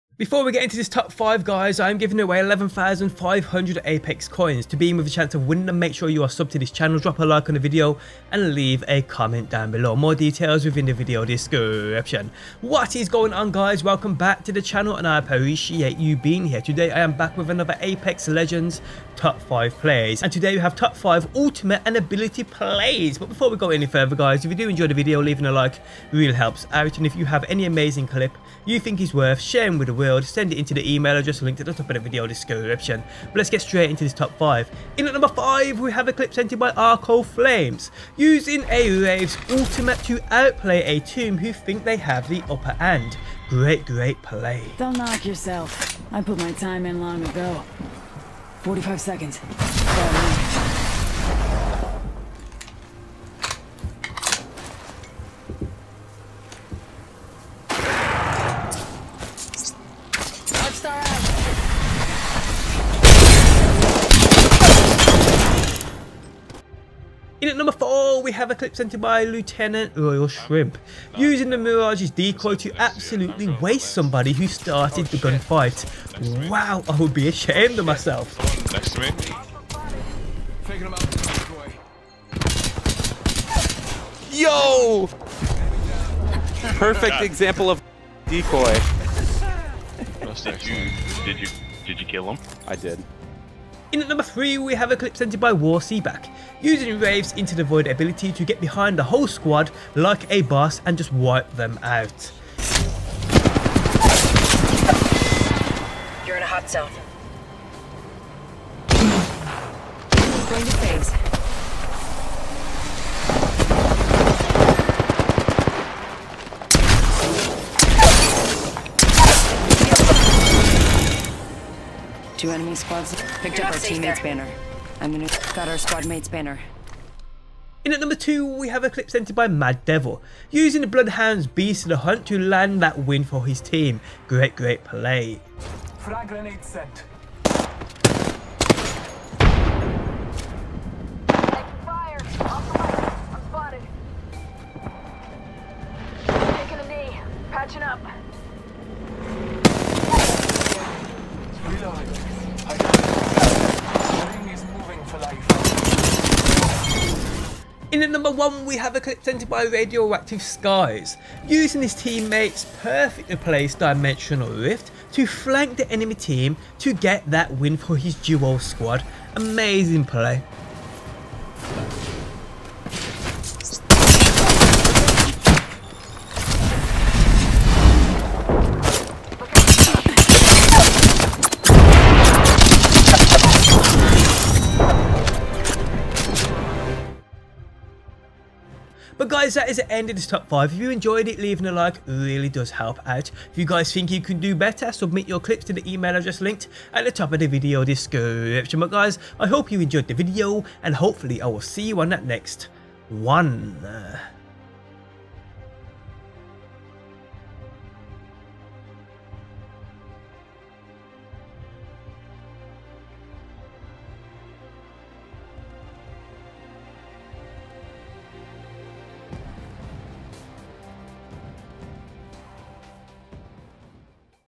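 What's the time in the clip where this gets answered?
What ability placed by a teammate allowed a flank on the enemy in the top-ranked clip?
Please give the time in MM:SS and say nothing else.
02:43.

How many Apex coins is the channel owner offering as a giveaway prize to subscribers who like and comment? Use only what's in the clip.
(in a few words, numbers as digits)
11,500.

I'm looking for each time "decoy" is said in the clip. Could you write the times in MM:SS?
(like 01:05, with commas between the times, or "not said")
01:12, 01:28.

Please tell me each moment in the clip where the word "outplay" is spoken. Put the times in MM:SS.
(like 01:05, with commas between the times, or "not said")
00:40.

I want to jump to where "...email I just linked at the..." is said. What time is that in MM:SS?
03:15.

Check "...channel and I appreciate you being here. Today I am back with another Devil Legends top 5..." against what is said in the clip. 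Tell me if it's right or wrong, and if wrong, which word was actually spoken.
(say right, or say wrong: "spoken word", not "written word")
wrong: "Apex", not "Devil".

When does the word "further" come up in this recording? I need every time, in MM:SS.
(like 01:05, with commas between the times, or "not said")
00:23.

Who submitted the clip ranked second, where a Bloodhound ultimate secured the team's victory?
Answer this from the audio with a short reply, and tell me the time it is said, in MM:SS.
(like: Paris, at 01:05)
Mad Devil, at 02:09.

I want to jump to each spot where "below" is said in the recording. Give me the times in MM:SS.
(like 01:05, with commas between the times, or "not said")
00:09.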